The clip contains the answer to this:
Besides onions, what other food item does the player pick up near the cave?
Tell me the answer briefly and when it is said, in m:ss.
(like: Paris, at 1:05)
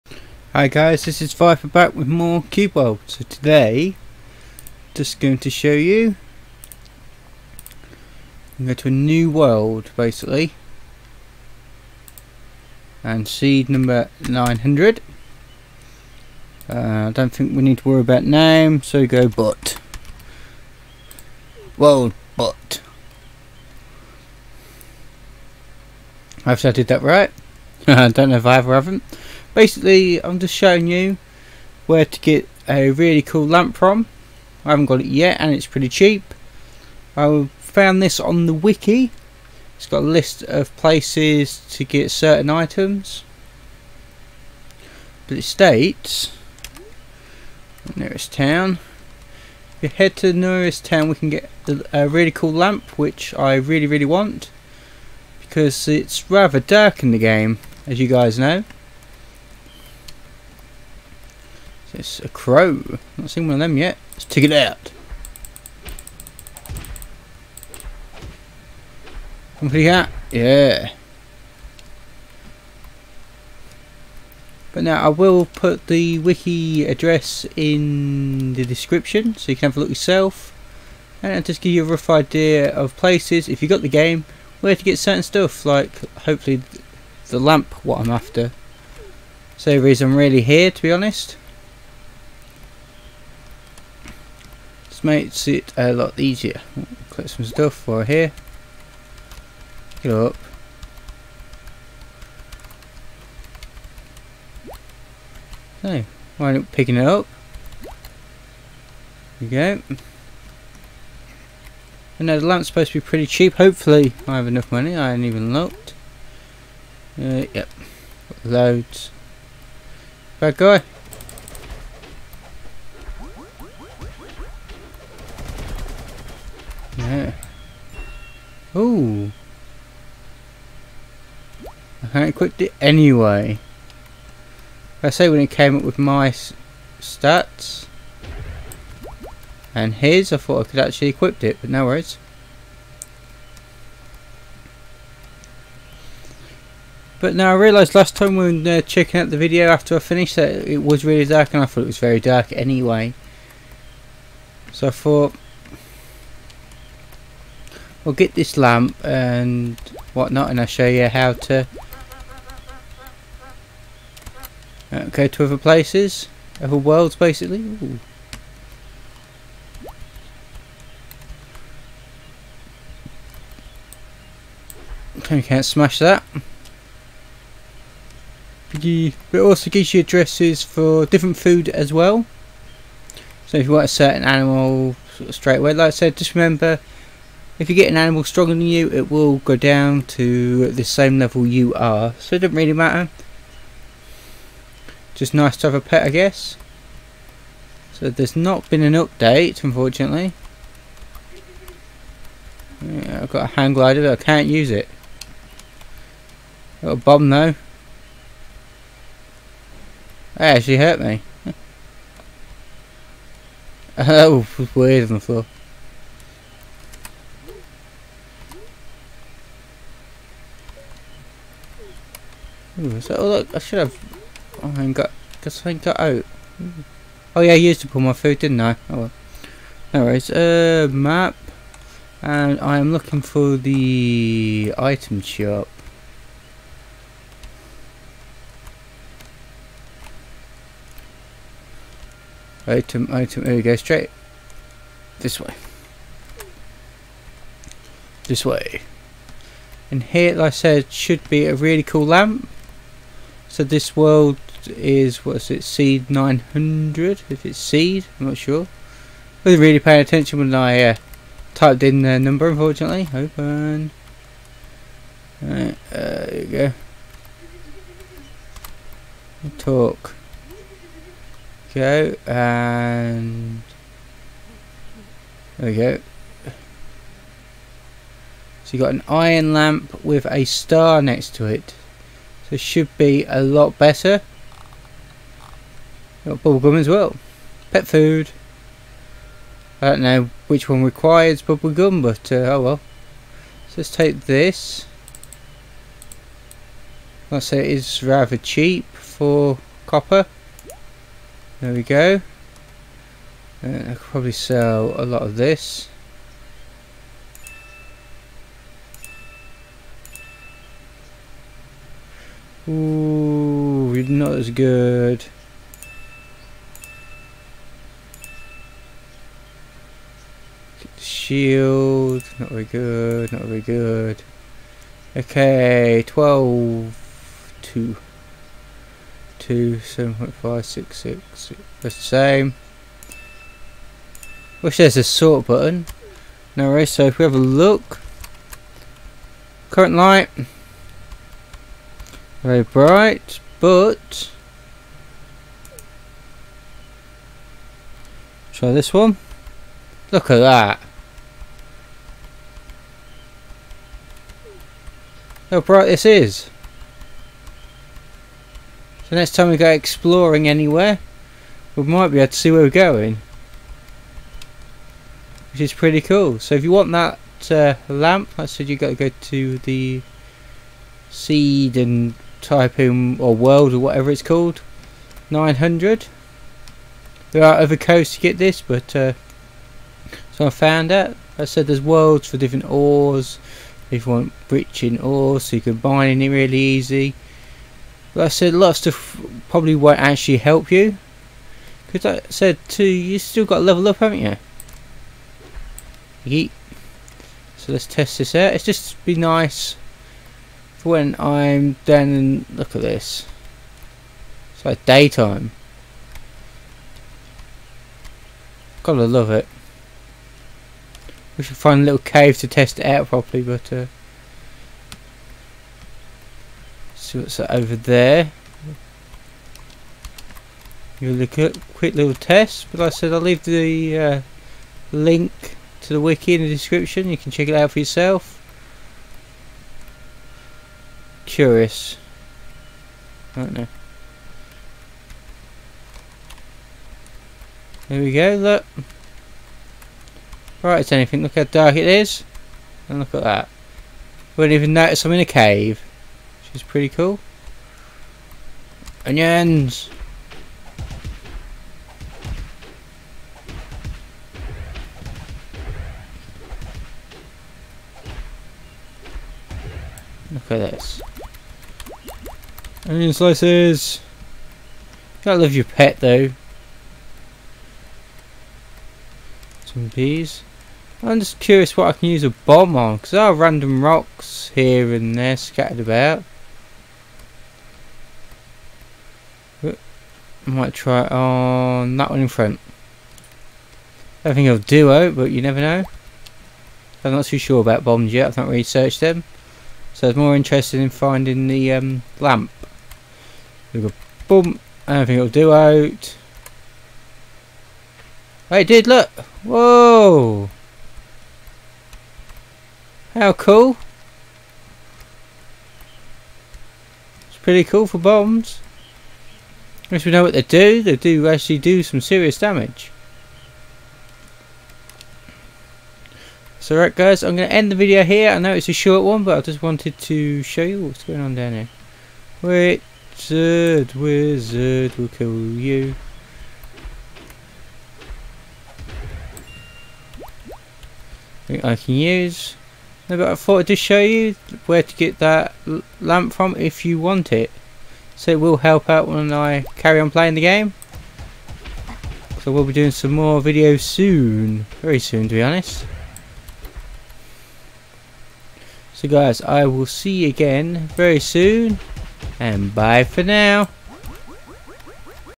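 Peas, at 7:49.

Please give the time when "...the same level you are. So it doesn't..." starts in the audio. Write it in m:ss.
3:10.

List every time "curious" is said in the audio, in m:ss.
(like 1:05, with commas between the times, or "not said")
7:11, 7:51.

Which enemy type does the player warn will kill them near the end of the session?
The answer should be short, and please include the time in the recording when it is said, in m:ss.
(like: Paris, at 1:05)
Wizard, at 8:43.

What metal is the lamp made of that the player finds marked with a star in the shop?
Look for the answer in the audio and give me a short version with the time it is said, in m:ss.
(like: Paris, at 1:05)
Iron, at 4:39.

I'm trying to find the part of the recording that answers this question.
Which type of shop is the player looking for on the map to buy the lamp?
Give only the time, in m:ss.
3:54.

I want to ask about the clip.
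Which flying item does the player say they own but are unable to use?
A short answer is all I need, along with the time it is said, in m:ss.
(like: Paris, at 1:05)
Hang glider, at 3:23.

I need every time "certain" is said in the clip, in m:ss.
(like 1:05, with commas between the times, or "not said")
0:42, 1:24, 3:03.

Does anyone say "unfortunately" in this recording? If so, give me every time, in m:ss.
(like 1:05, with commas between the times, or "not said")
3:19, 4:22.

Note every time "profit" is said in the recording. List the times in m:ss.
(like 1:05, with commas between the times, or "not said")
not said.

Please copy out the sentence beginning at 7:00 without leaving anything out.
You look at quick little test, but like I said I'll leave the uh, link to the wiki in the description.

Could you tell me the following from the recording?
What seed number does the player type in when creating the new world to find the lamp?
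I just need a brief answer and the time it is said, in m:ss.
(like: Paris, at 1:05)
900, at 0:13.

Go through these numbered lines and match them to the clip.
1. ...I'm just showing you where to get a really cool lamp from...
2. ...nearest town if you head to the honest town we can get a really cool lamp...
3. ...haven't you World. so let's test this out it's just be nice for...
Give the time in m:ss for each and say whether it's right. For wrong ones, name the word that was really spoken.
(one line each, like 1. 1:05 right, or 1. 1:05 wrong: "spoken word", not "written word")
1. 0:30 right
2. 0:47 wrong: "nearest", not "honest"
3. 6:33 wrong: "Yeet", not "World".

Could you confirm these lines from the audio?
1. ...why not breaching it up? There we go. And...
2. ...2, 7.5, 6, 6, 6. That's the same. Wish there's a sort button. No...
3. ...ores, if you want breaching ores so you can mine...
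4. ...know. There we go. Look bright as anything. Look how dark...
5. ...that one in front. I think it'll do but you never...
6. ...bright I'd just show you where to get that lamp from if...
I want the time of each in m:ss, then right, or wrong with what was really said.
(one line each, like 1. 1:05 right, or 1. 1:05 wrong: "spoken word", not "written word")
1. 1:46 wrong: "picking", not "breaching"
2. 5:29 right
3. 6:22 right
4. 7:13 right
5. 8:01 right
6. 8:53 wrong: "thought", not "bright".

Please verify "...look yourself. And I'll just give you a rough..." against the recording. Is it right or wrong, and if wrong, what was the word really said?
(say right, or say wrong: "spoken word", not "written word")
right.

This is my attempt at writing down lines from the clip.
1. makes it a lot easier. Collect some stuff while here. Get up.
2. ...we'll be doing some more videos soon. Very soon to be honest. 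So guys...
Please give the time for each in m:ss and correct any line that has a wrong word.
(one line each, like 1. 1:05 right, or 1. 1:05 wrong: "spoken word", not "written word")
1. 1:35 right
2. 9:02 right.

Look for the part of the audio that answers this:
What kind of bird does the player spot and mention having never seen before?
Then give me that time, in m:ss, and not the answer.
1:01.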